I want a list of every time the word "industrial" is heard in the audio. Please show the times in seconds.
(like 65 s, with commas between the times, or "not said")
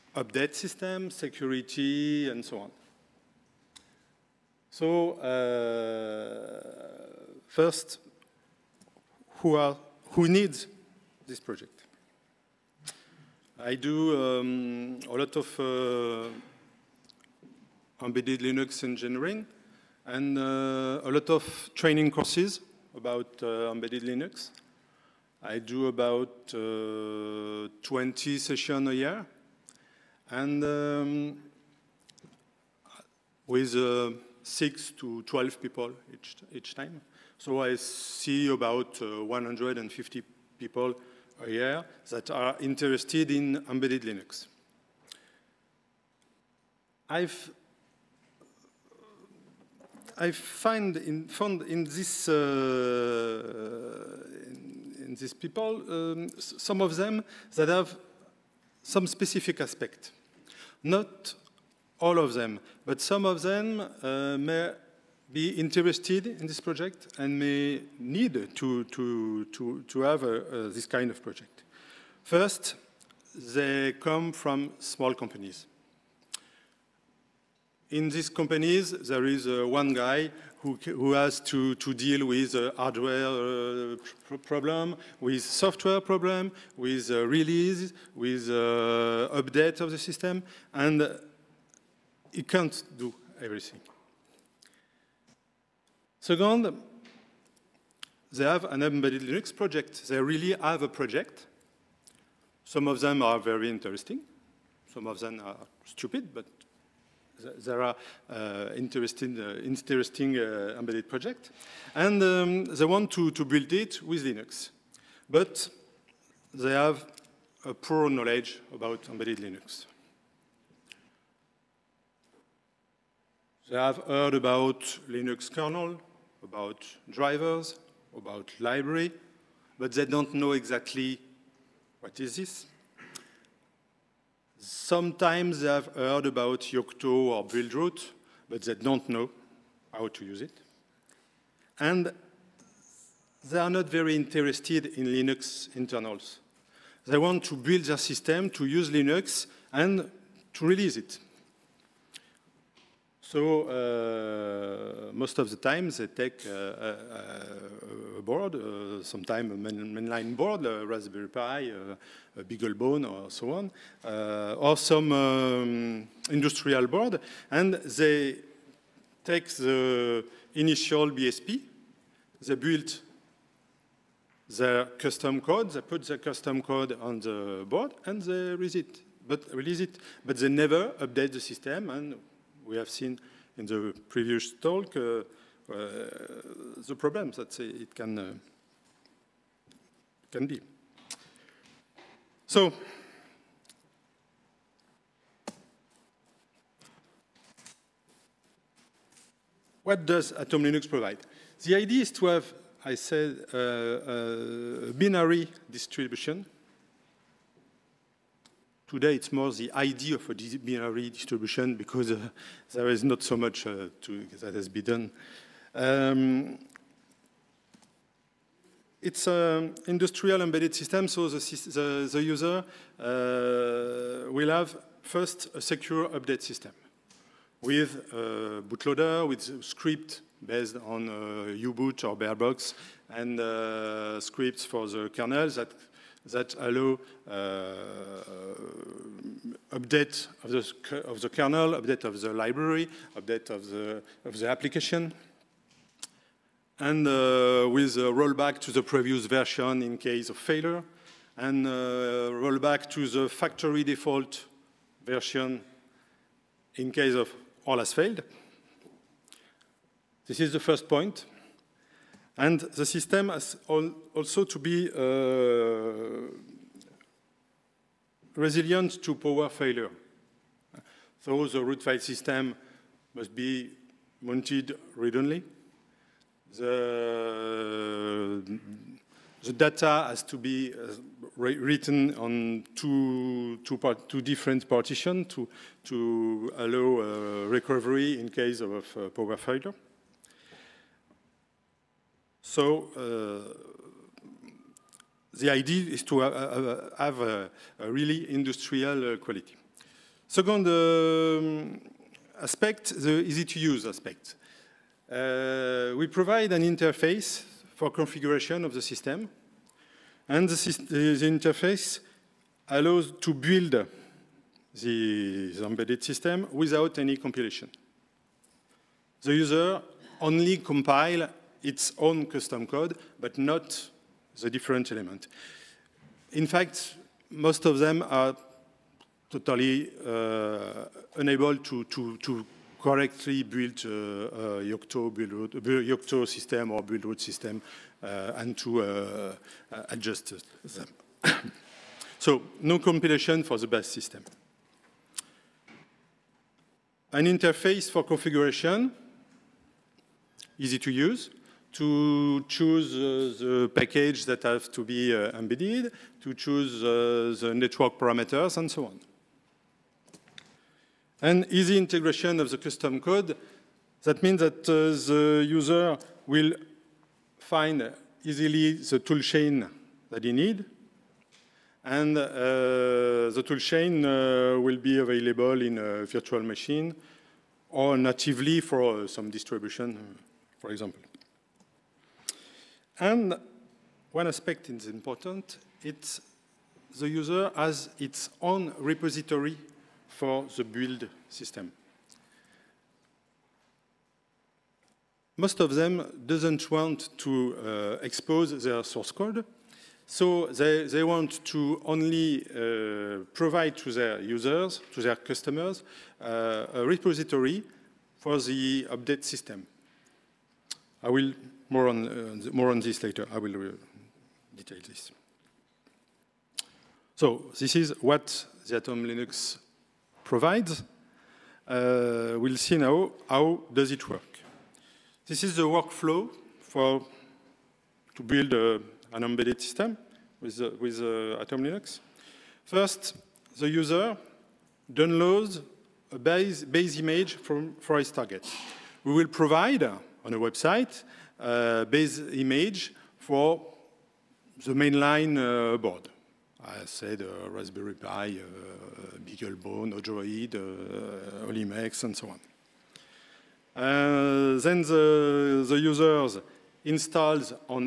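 166 s, 219 s, 298 s.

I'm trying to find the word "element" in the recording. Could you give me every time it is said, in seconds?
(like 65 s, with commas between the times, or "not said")
324 s.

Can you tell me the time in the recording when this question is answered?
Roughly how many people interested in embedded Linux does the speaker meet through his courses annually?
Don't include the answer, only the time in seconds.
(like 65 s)
39 s.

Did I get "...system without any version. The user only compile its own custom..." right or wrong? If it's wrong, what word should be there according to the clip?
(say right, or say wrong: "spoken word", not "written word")
wrong: "compilation", not "version".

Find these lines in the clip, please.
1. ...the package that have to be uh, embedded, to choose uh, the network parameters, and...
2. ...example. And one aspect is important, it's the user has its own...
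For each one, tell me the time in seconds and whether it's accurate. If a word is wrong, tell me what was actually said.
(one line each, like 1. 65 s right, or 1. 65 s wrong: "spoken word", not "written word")
1. 353 s right
2. 380 s right.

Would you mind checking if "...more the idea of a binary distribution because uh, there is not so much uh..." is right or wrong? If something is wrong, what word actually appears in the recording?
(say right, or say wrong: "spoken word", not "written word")
right.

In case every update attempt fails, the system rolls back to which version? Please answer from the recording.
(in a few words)
factory default version.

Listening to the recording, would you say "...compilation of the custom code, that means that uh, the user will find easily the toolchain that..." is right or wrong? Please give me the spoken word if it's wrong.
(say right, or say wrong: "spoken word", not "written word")
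wrong: "integration", not "compilation".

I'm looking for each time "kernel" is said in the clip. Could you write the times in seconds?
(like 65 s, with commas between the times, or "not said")
125 s, 235 s, 241 s.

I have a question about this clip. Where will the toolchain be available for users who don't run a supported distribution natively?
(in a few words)
a virtual machine.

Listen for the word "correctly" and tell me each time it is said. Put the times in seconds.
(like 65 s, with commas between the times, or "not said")
332 s.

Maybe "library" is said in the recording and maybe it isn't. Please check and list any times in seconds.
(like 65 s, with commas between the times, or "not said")
128 s, 242 s.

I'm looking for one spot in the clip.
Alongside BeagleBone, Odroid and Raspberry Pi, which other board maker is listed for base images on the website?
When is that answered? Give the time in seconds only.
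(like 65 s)
451 s.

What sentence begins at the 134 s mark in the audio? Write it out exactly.
Sometimes they have heard about Yocto or Buildroot, but they don't know how to use it.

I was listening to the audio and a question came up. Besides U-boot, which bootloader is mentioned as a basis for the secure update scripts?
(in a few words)
barebox.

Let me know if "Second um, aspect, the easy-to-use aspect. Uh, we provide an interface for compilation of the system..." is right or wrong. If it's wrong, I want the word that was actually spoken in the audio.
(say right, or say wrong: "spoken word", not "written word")
wrong: "configuration", not "compilation".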